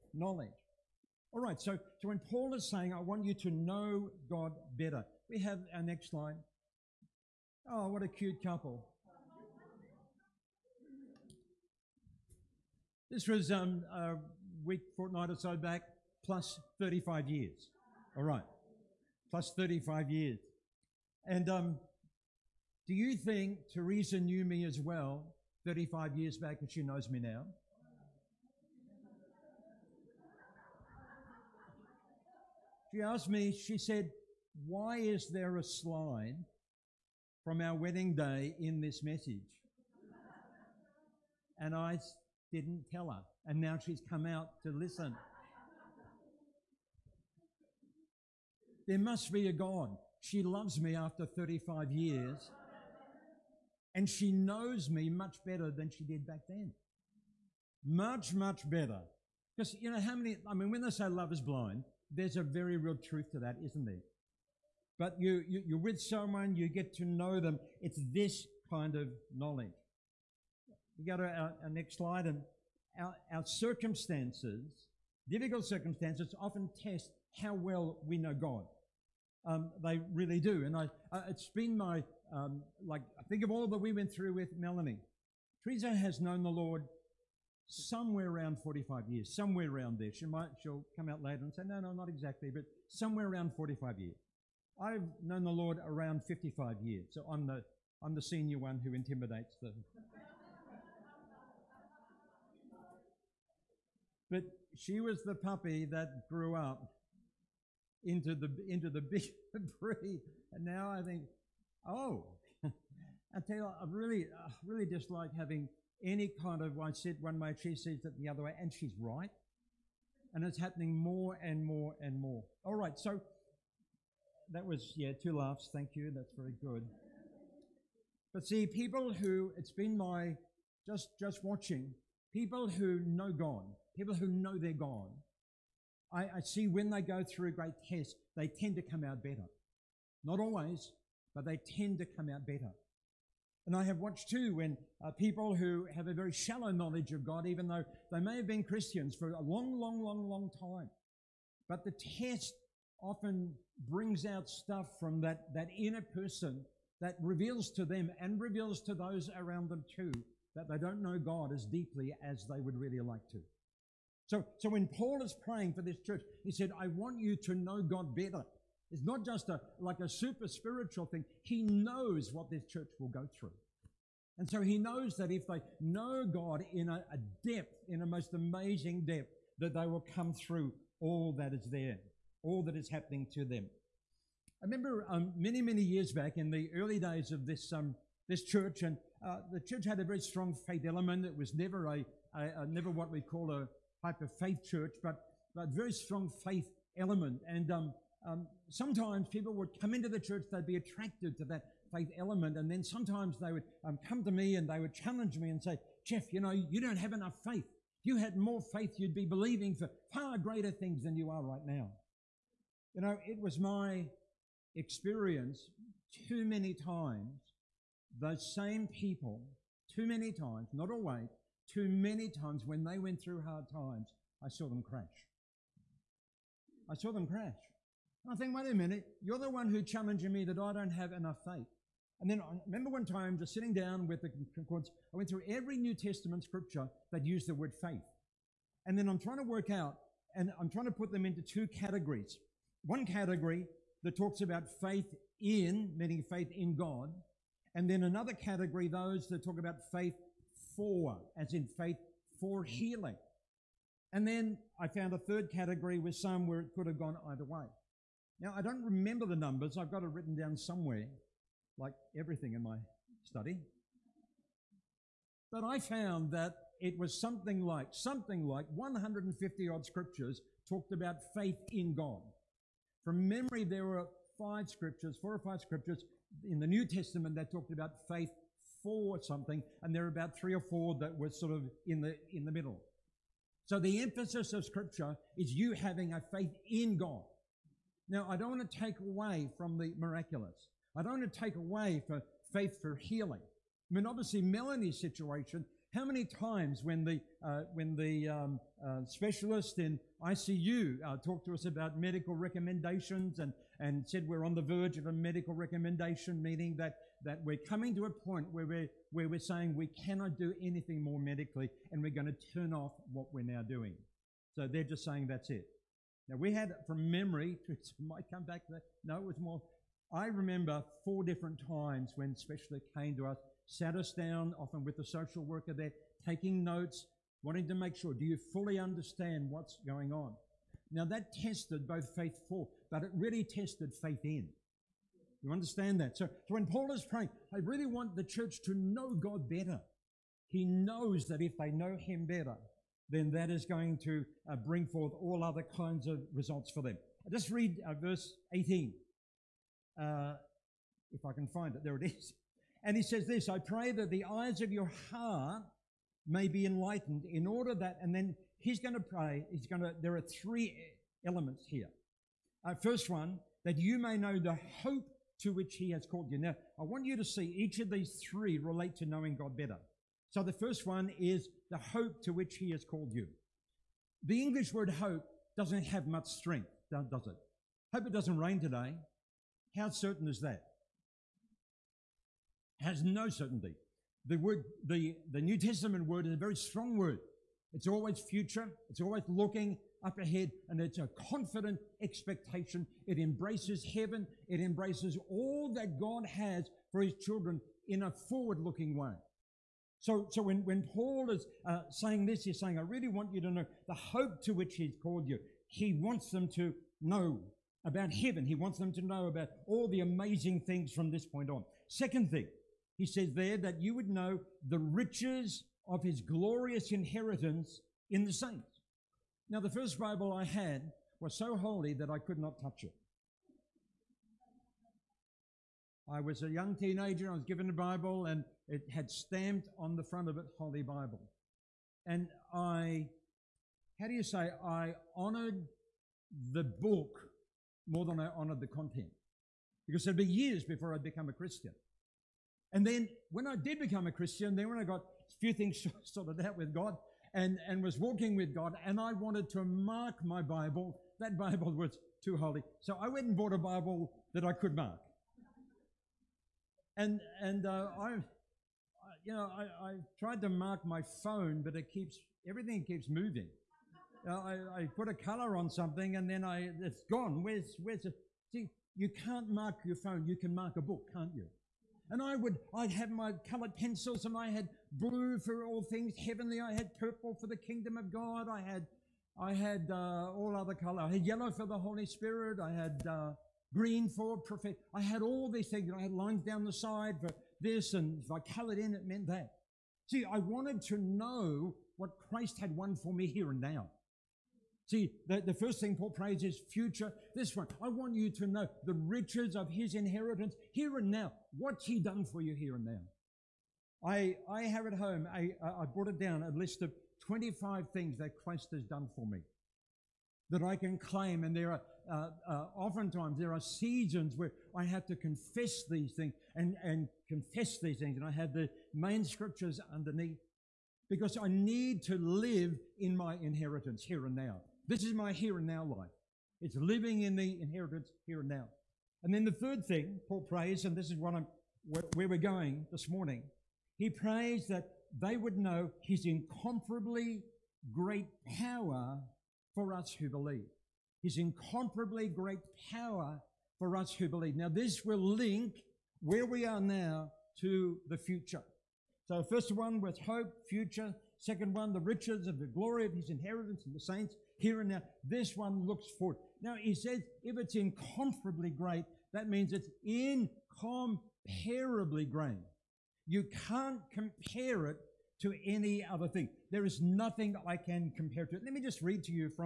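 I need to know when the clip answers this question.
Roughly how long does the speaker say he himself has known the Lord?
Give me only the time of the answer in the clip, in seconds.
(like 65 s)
96 s.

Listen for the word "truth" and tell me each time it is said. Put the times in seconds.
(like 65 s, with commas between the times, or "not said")
62 s.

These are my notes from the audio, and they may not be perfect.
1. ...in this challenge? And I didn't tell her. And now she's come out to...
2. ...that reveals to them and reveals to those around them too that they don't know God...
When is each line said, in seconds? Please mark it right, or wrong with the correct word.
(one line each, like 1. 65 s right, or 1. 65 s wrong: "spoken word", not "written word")
1. 38 s wrong: "message", not "challenge"
2. 156 s right.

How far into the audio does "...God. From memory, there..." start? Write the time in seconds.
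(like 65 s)
271 s.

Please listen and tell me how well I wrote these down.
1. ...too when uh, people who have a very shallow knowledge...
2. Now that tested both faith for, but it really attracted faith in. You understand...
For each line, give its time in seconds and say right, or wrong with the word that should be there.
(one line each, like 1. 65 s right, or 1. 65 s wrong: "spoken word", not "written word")
1. 144 s right
2. 330 s wrong: "tested", not "attracted".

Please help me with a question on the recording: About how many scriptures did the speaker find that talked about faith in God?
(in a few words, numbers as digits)
150.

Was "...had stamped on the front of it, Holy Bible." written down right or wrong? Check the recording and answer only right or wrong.
right.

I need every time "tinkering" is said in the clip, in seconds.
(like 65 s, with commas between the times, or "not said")
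not said.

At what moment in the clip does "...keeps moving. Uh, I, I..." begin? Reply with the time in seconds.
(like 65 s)
462 s.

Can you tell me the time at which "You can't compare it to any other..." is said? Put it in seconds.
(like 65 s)
563 s.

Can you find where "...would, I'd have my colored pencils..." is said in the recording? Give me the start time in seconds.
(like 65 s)
472 s.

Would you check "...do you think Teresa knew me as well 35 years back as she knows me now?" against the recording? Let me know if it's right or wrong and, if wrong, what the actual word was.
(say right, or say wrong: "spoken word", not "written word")
right.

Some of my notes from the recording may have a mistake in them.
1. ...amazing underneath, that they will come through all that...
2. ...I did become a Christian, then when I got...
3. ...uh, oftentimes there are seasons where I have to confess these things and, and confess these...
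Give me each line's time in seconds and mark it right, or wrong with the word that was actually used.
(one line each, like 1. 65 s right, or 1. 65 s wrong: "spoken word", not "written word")
1. 178 s wrong: "depth", not "underneath"
2. 443 s right
3. 512 s right.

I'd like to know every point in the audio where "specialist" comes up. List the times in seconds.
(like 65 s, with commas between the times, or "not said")
299 s, 322 s.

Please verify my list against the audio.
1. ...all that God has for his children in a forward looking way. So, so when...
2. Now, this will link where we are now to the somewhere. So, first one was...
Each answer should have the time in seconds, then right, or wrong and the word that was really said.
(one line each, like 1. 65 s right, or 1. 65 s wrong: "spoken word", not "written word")
1. 395 s right
2. 544 s wrong: "future", not "somewhere".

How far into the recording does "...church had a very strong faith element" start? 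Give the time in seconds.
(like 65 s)
189 s.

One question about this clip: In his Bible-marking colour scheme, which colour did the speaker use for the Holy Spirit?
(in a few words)
yellow.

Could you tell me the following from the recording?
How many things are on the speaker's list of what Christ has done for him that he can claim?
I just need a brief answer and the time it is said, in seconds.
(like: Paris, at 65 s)
25, at 507 s.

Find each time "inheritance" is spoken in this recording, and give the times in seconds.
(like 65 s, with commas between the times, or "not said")
416 s, 499 s, 523 s, 527 s, 553 s.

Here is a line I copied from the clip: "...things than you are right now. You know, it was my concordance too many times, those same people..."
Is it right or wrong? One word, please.
wrong.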